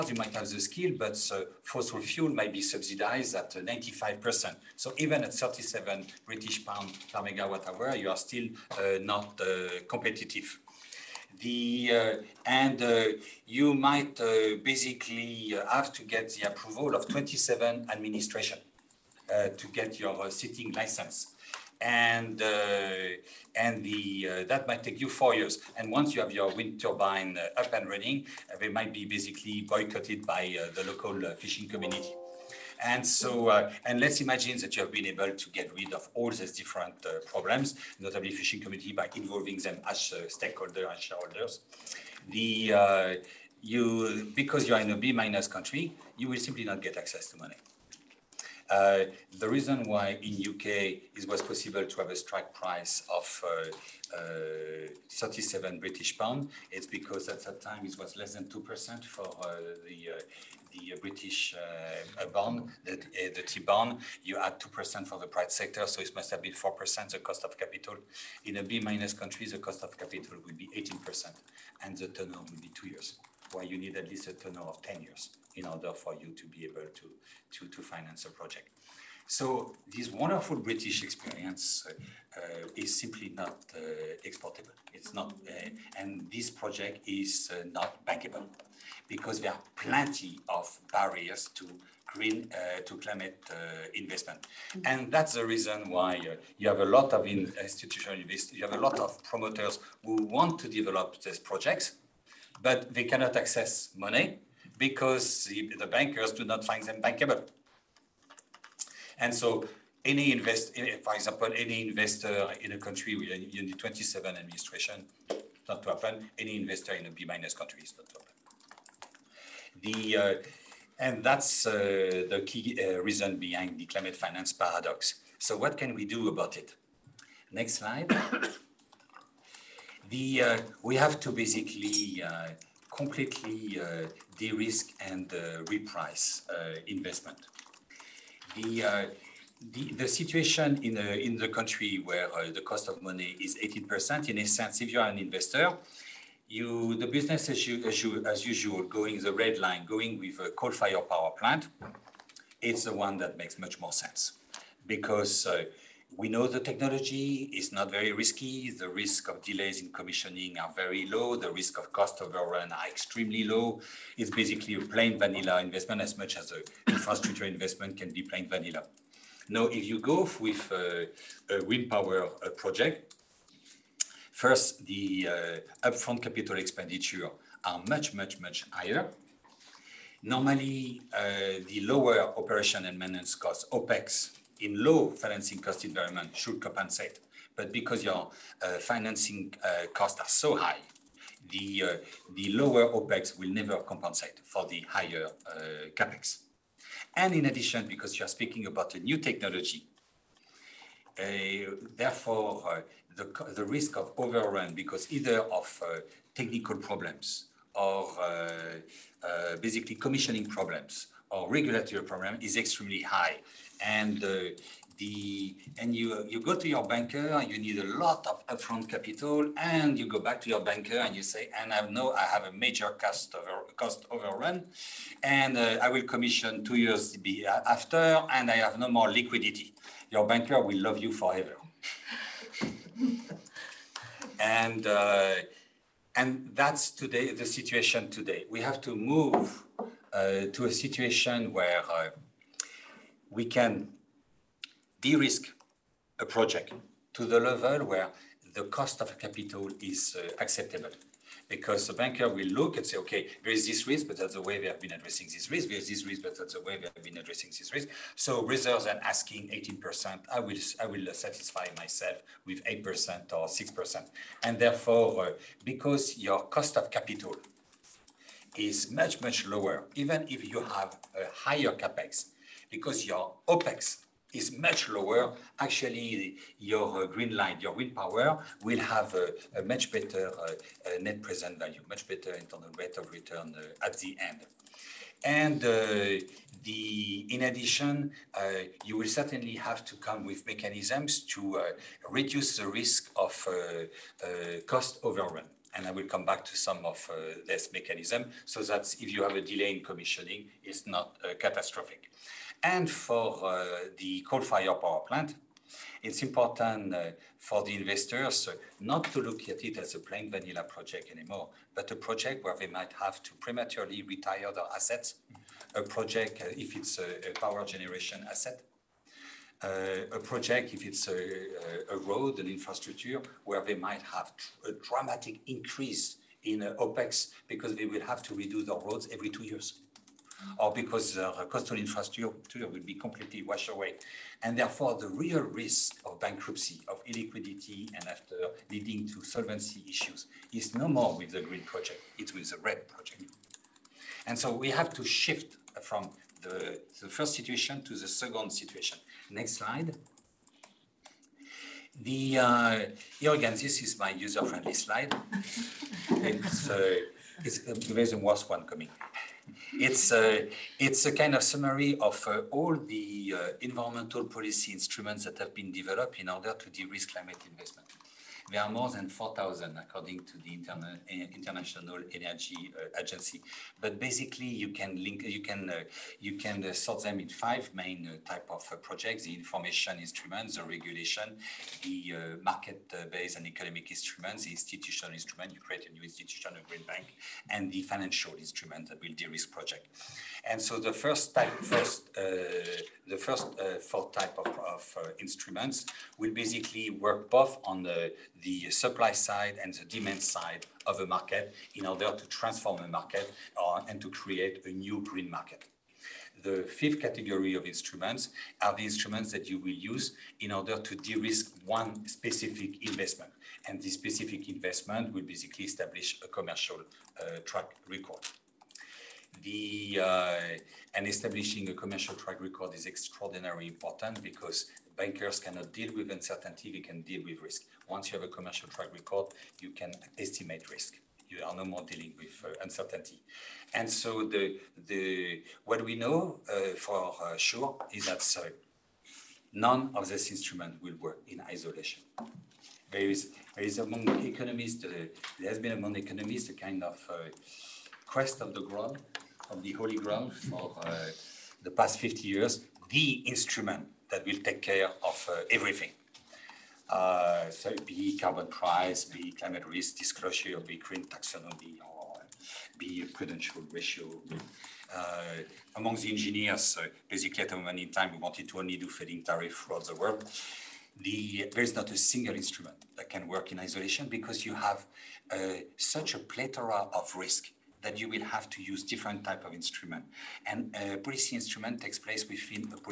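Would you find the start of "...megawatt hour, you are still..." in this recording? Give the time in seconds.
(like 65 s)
7 s.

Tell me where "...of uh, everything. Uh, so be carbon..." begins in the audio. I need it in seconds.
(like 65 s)
455 s.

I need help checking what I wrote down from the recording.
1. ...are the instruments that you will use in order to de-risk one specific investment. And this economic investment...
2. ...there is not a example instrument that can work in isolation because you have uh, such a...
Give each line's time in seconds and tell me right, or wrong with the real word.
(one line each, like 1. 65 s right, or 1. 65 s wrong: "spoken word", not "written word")
1. 408 s wrong: "specific", not "economic"
2. 471 s wrong: "single", not "example".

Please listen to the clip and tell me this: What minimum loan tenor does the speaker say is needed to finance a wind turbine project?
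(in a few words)
10 years.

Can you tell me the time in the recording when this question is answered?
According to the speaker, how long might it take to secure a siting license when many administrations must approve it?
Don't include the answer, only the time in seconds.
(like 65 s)
25 s.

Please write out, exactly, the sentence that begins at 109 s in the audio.
And so any invest, eh, for example, any investor in a country with in the 27 administration, not to happen.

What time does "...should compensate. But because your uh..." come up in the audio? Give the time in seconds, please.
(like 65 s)
186 s.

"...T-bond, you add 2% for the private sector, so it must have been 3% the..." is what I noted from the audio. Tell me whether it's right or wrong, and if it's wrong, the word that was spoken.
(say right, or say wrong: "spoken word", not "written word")
wrong: "4", not "3".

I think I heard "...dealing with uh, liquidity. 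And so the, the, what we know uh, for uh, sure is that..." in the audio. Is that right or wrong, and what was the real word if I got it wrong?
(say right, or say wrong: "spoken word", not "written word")
wrong: "uncertainty", not "liquidity".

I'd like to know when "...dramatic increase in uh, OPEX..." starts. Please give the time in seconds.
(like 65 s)
324 s.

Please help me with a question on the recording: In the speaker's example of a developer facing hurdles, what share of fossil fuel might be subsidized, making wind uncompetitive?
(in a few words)
95%.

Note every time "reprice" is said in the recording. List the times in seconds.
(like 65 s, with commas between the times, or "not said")
135 s.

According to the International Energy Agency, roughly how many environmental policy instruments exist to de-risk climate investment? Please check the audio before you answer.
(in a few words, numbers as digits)
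more than 4,000.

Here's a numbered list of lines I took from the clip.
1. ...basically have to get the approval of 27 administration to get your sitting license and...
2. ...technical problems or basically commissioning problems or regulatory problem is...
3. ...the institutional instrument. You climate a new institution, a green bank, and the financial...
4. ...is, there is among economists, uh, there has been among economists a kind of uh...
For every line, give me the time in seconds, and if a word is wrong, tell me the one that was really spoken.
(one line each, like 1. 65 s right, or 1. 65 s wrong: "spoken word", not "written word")
1. 14 s right
2. 206 s right
3. 384 s wrong: "create", not "climate"
4. 443 s right.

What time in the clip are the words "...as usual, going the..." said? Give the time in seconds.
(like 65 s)
148 s.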